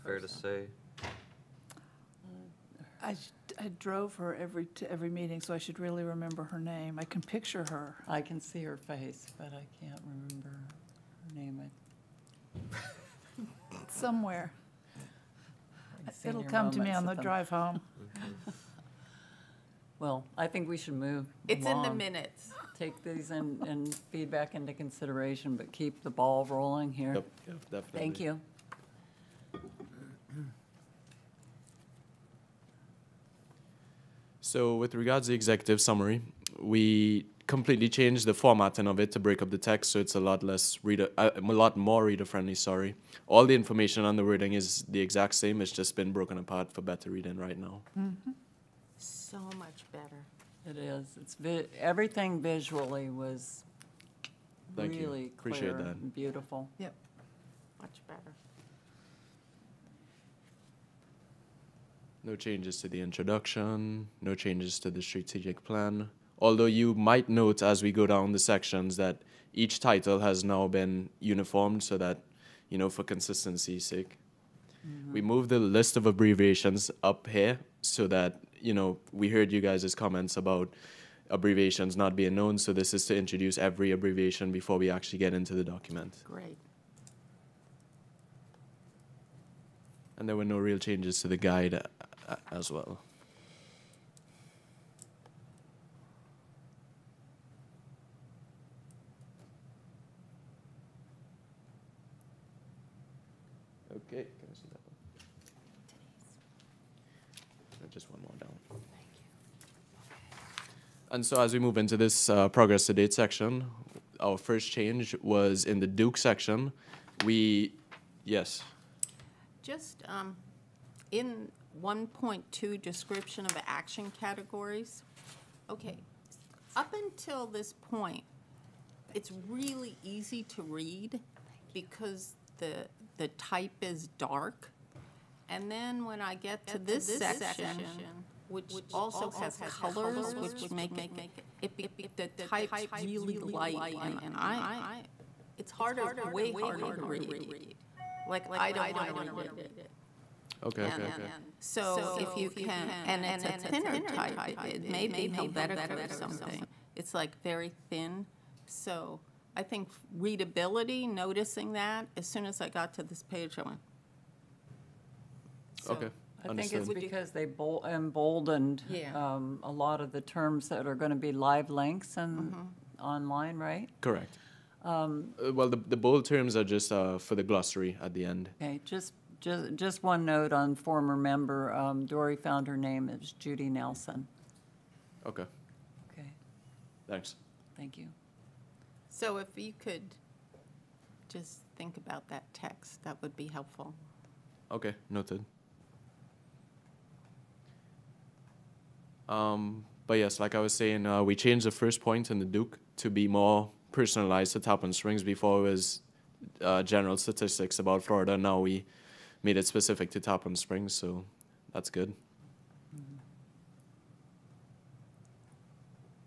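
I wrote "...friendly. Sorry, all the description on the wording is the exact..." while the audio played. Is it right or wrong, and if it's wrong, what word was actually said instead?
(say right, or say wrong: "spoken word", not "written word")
wrong: "information", not "description".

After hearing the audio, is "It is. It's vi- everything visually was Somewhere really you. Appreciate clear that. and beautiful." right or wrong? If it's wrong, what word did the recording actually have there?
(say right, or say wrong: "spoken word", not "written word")
wrong: "Thank", not "Somewhere".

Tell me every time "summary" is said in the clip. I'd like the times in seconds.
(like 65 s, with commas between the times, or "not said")
35 s.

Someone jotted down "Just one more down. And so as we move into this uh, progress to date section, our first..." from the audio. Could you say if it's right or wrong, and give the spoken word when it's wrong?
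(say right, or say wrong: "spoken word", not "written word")
right.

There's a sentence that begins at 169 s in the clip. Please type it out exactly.
um, a lot of the terms that are going to be live links and mm-hmm.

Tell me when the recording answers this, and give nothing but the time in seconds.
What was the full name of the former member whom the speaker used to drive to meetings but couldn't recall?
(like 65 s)
183 s.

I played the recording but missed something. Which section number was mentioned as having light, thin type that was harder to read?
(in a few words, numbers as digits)
1.2.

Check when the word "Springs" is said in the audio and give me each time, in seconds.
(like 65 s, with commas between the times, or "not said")
204 s, 210 s.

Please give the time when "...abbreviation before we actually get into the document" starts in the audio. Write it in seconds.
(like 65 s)
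83 s.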